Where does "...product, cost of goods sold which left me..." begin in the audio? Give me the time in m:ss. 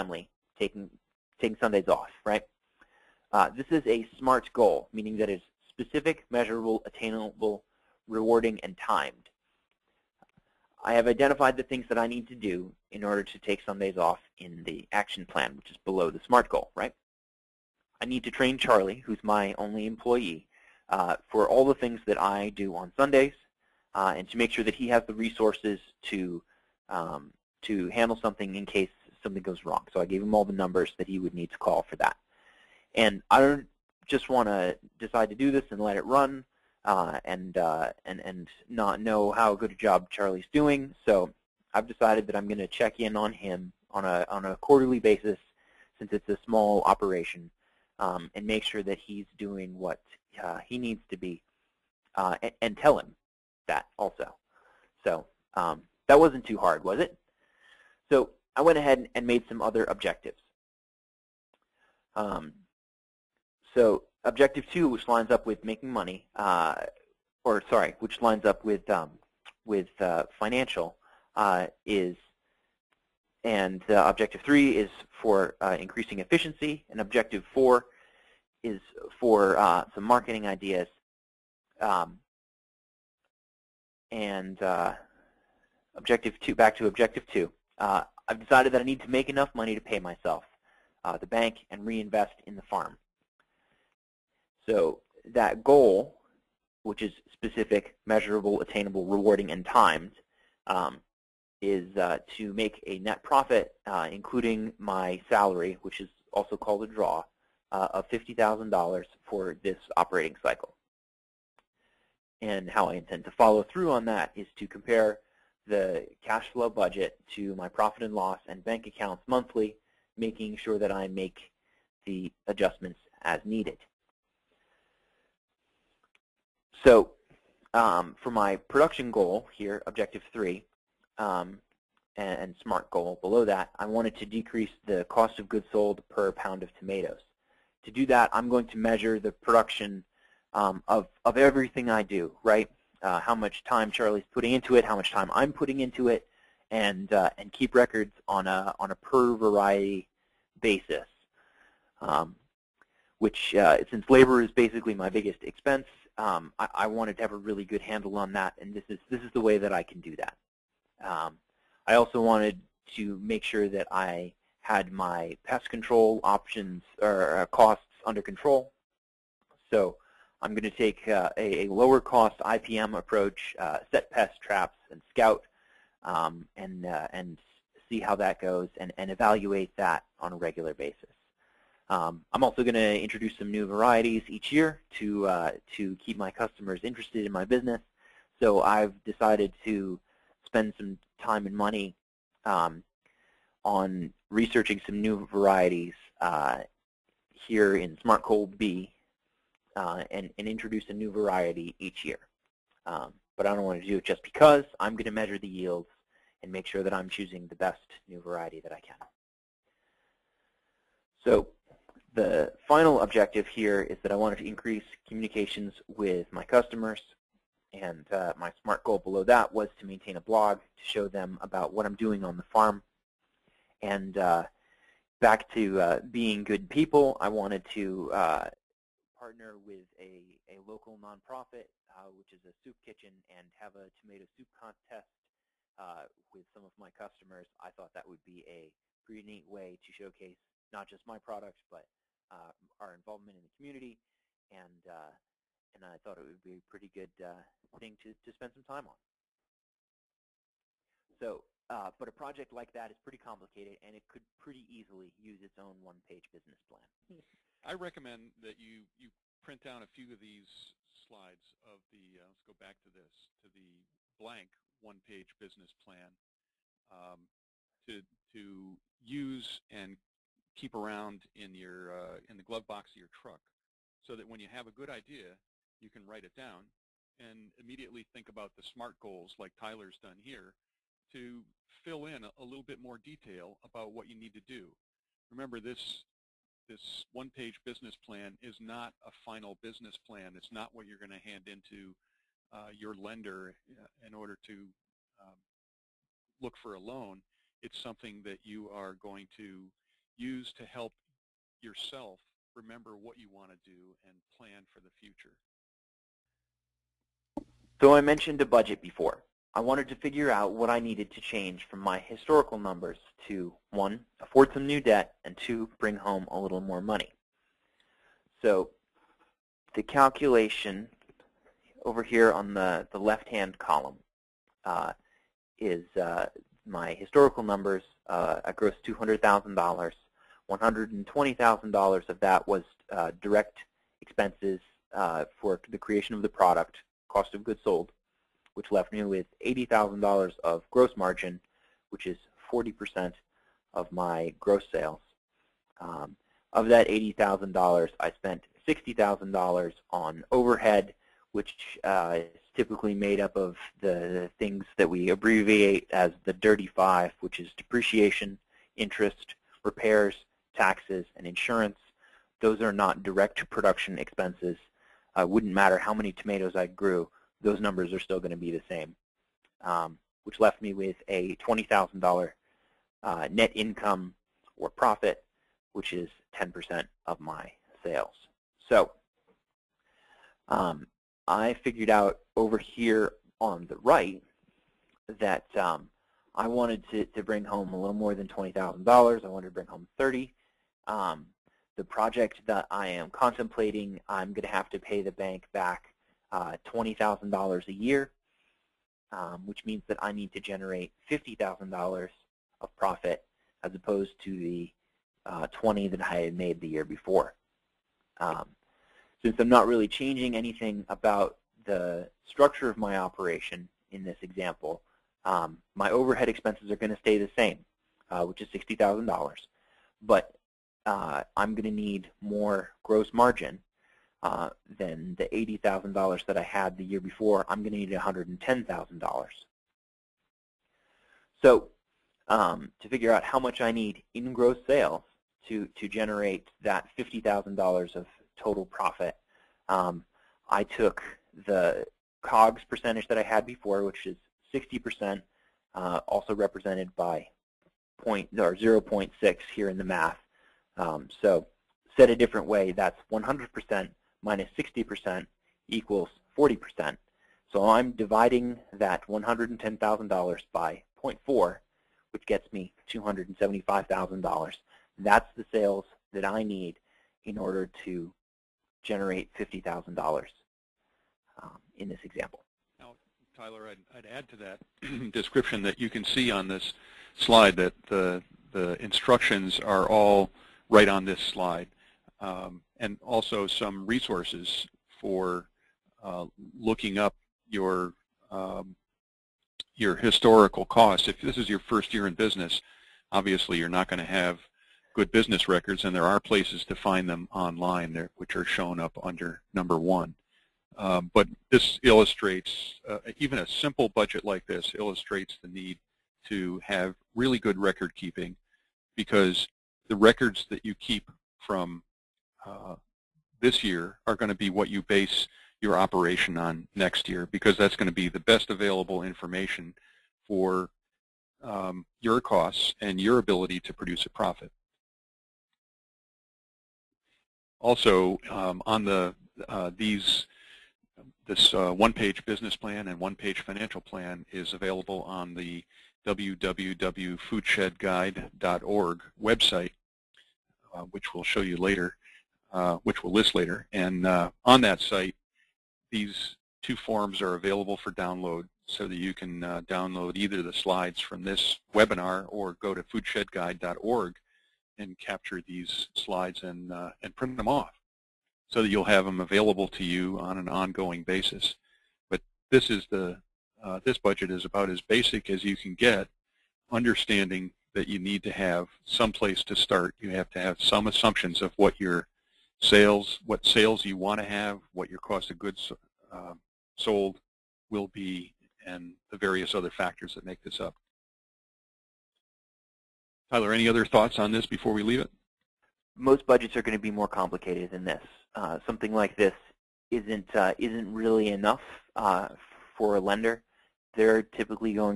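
5:36.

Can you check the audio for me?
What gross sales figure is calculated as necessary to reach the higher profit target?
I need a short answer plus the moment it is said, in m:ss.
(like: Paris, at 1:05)
$275,000, at 7:42.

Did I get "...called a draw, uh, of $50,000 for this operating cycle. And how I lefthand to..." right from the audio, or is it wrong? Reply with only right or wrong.
wrong.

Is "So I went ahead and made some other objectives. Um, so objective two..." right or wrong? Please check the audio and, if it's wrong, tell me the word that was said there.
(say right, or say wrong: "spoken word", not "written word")
right.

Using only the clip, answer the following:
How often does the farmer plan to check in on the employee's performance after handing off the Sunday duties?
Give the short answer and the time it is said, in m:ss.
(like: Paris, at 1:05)
Quarterly, at 0:44.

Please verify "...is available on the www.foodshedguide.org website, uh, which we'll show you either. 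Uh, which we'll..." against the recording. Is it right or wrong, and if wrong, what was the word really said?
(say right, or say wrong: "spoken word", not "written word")
wrong: "later", not "either".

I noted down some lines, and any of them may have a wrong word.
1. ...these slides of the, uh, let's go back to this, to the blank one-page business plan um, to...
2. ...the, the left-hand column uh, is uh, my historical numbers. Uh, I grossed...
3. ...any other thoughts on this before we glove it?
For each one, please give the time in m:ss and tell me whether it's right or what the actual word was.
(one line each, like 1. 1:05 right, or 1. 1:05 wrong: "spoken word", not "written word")
1. 4:20 right
2. 5:22 right
3. 9:43 wrong: "leave", not "glove".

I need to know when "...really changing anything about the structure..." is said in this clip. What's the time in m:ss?
6:49.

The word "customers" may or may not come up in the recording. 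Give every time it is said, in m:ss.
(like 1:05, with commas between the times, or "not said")
3:06, 3:36, 3:56.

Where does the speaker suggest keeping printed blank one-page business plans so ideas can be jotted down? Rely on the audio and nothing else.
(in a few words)
Glove box.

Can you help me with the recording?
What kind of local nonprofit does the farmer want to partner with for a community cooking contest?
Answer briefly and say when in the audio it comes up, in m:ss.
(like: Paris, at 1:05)
Soup kitchen, at 3:52.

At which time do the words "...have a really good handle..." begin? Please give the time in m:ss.
2:37.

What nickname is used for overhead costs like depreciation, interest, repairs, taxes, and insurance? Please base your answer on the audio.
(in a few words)
Dirty five.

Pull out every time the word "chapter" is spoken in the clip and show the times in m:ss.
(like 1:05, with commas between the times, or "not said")
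not said.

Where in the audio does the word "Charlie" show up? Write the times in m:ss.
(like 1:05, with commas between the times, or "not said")
0:18, 0:40, 2:23.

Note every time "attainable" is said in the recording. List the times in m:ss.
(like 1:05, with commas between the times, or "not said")
0:06, 1:38.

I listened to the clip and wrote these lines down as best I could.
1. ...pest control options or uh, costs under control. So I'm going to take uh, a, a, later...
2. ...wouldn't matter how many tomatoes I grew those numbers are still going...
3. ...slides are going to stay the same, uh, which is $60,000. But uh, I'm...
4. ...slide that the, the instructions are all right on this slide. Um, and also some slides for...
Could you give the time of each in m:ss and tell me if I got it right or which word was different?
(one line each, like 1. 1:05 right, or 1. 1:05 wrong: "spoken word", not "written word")
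1. 2:45 wrong: "lower", not "later"
2. 6:05 right
3. 6:56 wrong: "expenses", not "slides"
4. 7:57 wrong: "resources", not "slides".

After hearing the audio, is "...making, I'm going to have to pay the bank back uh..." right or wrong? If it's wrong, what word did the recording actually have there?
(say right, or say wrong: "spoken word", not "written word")
wrong: "contemplating", not "making".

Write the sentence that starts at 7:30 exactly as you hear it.
Um, so said a different way, that's 100% minus 60% equals 40%.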